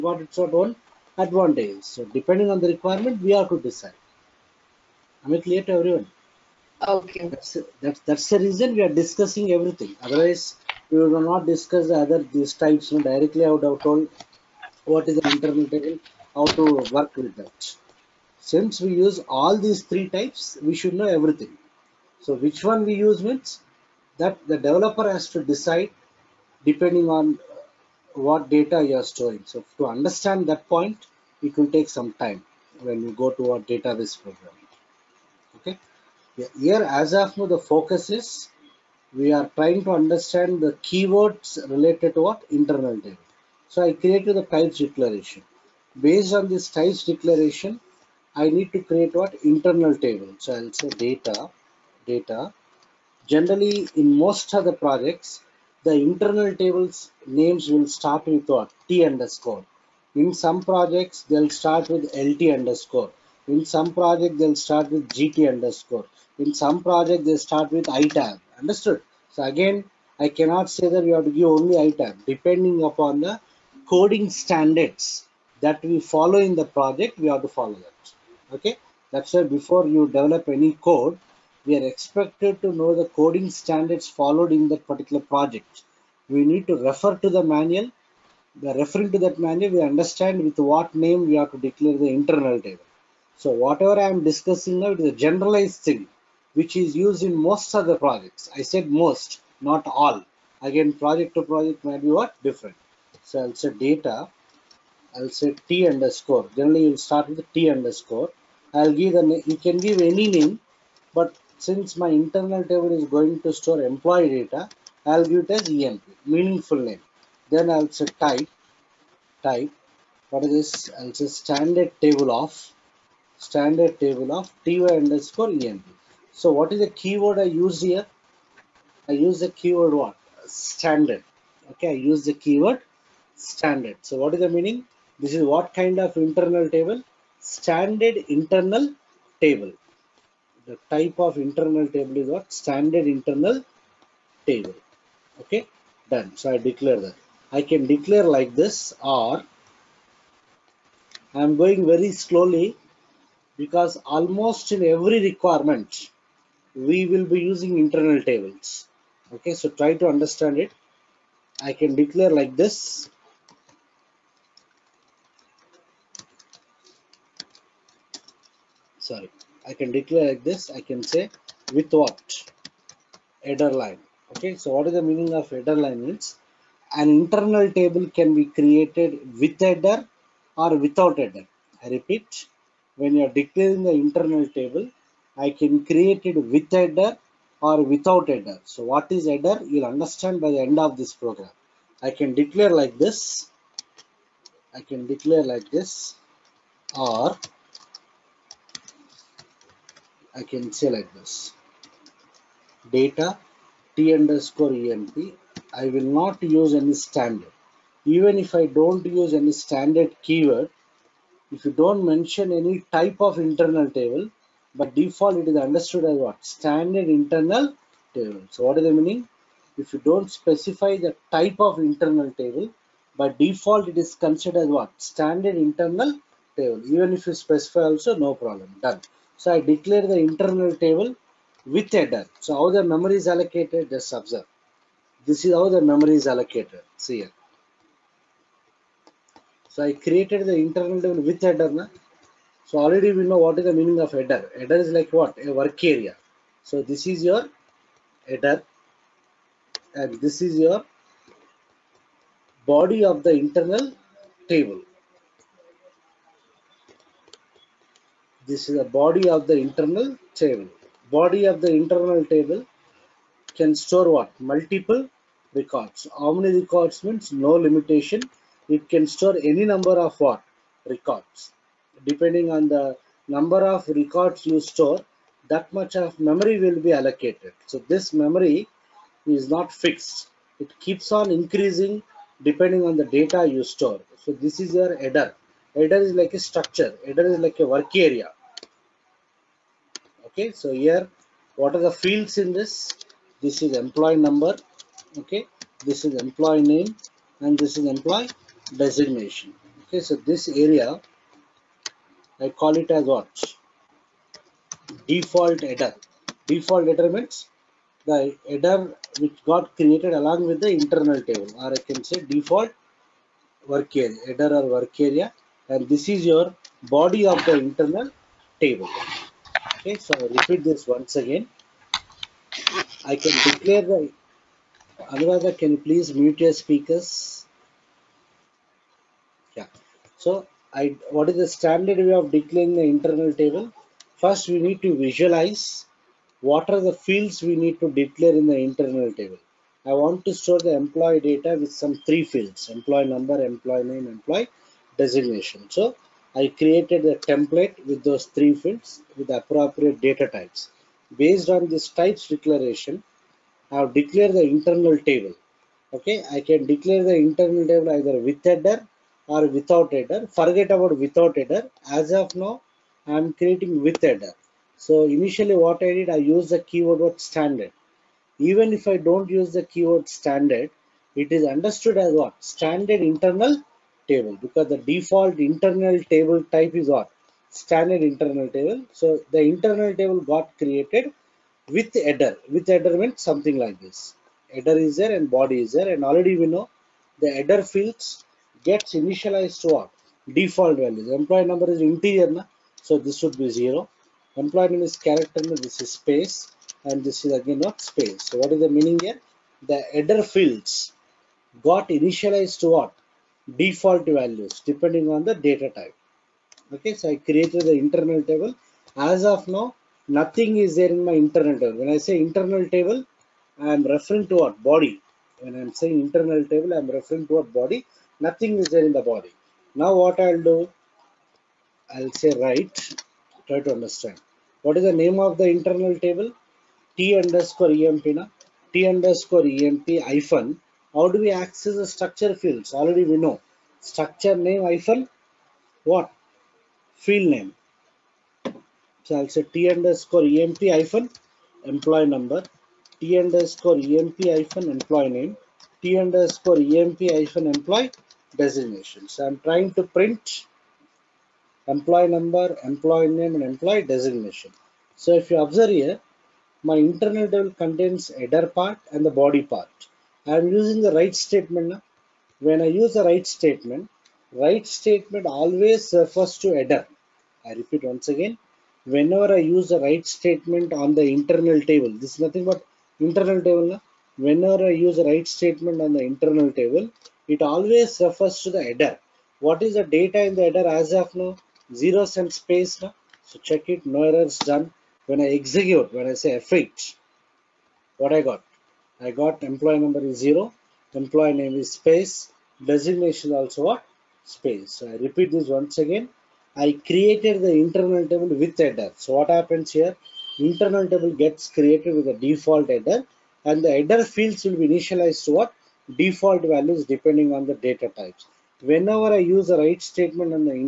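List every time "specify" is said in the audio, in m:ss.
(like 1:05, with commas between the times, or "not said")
3:40, 3:47.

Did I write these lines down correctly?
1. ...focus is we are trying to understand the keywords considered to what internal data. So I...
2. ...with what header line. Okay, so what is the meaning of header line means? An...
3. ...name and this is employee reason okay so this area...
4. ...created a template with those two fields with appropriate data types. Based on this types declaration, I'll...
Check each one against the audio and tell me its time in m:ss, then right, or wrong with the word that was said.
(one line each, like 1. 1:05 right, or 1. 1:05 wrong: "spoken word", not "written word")
1. 0:37 wrong: "related", not "considered"
2. 2:51 right
3. 4:56 wrong: "designation", not "reason"
4. 5:46 wrong: "three", not "two".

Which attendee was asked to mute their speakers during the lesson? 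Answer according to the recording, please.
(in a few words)
Anuradha.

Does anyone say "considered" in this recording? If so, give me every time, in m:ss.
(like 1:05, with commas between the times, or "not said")
3:44.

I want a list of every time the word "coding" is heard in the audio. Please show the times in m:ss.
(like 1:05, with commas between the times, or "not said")
1:13, 1:23.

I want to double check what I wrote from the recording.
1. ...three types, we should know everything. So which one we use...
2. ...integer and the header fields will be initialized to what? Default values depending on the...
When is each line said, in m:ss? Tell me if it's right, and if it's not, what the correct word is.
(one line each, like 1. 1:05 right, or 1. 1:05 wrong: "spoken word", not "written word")
1. 0:19 right
2. 8:22 wrong: "header", not "integer".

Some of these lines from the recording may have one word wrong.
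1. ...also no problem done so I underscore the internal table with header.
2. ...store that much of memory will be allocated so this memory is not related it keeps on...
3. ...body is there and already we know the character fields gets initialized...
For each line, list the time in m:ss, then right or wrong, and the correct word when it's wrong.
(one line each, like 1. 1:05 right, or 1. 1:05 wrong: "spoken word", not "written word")
1. 3:47 wrong: "declare", not "underscore"
2. 4:34 wrong: "fixed", not "related"
3. 6:25 wrong: "header", not "character".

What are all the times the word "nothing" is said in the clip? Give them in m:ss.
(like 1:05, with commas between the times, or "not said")
6:50, 6:58, 7:52.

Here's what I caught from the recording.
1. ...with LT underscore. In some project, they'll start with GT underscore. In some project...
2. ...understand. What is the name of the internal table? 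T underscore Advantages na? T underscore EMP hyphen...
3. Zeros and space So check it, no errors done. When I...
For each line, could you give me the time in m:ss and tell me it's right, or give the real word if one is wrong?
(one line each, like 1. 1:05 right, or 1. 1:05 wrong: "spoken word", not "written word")
1. 1:01 right
2. 7:03 wrong: "EMP", not "Advantages"
3. 8:01 right.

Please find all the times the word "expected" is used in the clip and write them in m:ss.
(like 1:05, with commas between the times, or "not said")
1:21.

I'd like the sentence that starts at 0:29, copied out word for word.
So to understand that point, it will take some time when we go to our database program.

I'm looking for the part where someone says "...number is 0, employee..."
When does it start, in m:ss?
8:09.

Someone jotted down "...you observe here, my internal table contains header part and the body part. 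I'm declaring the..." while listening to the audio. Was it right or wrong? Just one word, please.
wrong.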